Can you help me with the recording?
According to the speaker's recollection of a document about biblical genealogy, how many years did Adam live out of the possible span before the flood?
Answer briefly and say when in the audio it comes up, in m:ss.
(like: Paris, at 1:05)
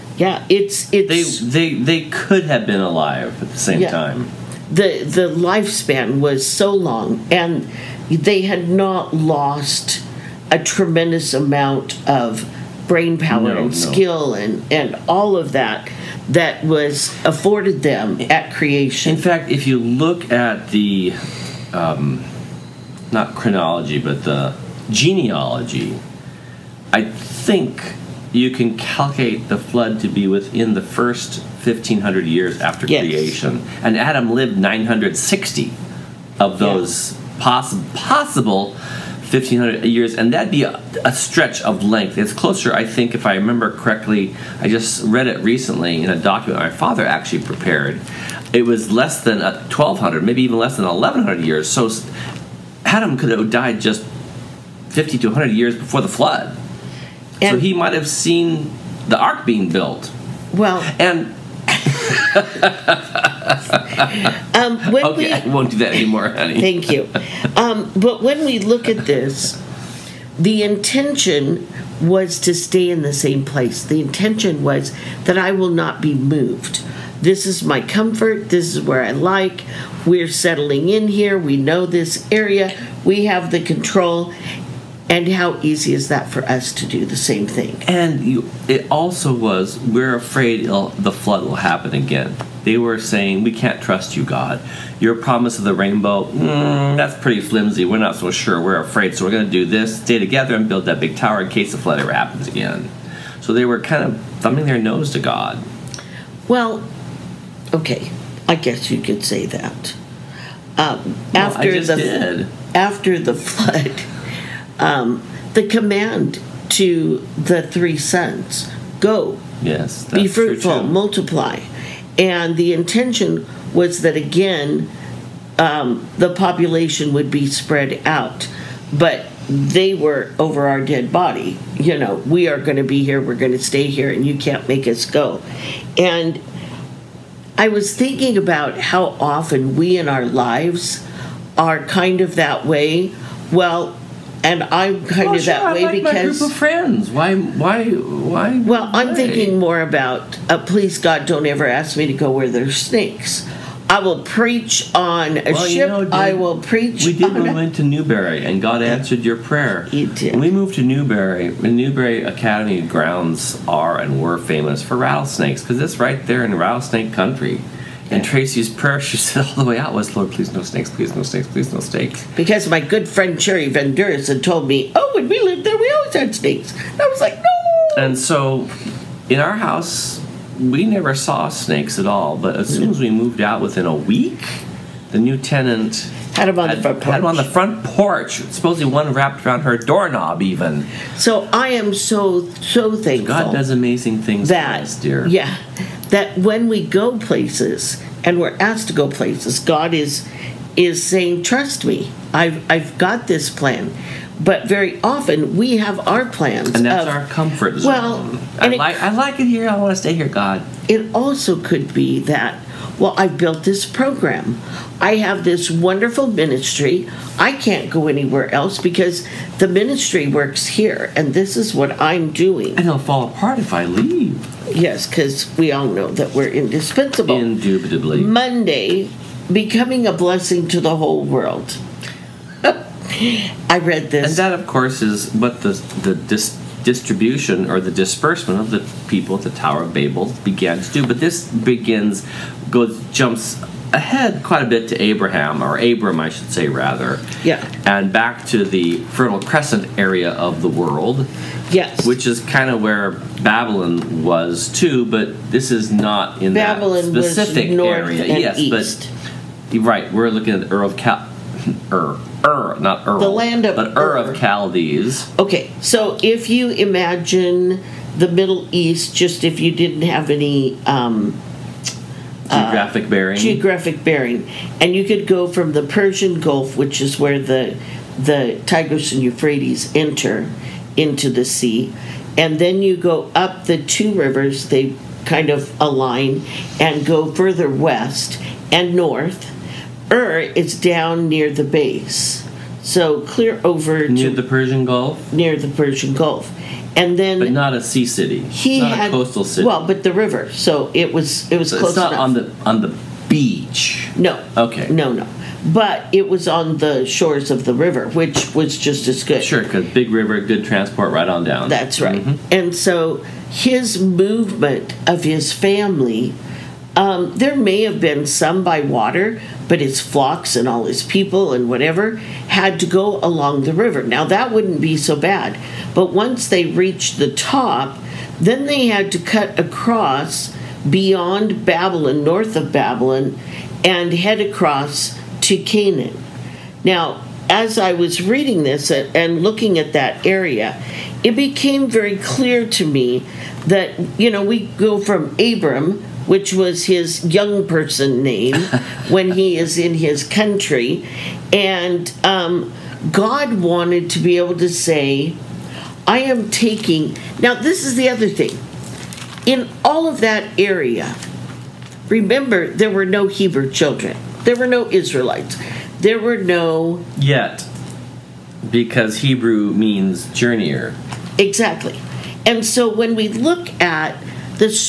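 960, at 0:34.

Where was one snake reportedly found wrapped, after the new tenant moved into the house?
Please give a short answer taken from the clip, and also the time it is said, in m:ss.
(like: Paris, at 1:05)
her doorknob, at 3:09.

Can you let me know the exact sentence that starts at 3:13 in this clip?
God does amazing things that, us, dear.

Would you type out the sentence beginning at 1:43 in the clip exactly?
So they were kind of thumbing their nose to God.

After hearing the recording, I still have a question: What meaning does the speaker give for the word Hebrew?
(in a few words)
journeyer.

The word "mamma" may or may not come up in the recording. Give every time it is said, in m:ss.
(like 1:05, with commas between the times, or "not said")
not said.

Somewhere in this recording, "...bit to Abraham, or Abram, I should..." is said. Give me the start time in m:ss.
4:04.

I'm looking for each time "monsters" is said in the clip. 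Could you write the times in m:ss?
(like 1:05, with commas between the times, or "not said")
not said.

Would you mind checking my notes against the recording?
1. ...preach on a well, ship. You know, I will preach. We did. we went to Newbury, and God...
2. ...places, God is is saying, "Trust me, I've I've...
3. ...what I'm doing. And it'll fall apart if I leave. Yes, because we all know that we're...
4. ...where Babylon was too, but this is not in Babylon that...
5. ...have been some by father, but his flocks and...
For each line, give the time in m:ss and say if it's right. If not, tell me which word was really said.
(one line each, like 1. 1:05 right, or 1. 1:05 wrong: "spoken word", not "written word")
1. 2:34 right
2. 3:19 right
3. 3:41 right
4. 4:12 right
5. 5:17 wrong: "water", not "father".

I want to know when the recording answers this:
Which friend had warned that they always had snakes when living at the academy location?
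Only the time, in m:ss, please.
2:53.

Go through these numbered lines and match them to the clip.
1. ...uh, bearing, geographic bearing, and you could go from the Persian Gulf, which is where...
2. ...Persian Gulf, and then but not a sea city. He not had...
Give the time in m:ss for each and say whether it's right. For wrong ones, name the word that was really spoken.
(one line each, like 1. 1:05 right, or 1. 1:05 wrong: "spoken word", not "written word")
1. 4:33 right
2. 4:55 right.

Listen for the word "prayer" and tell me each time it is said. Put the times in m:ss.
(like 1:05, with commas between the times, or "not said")
2:39, 2:48.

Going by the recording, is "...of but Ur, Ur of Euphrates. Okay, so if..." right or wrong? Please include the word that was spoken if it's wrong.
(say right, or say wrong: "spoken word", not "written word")
wrong: "Chaldees", not "Euphrates".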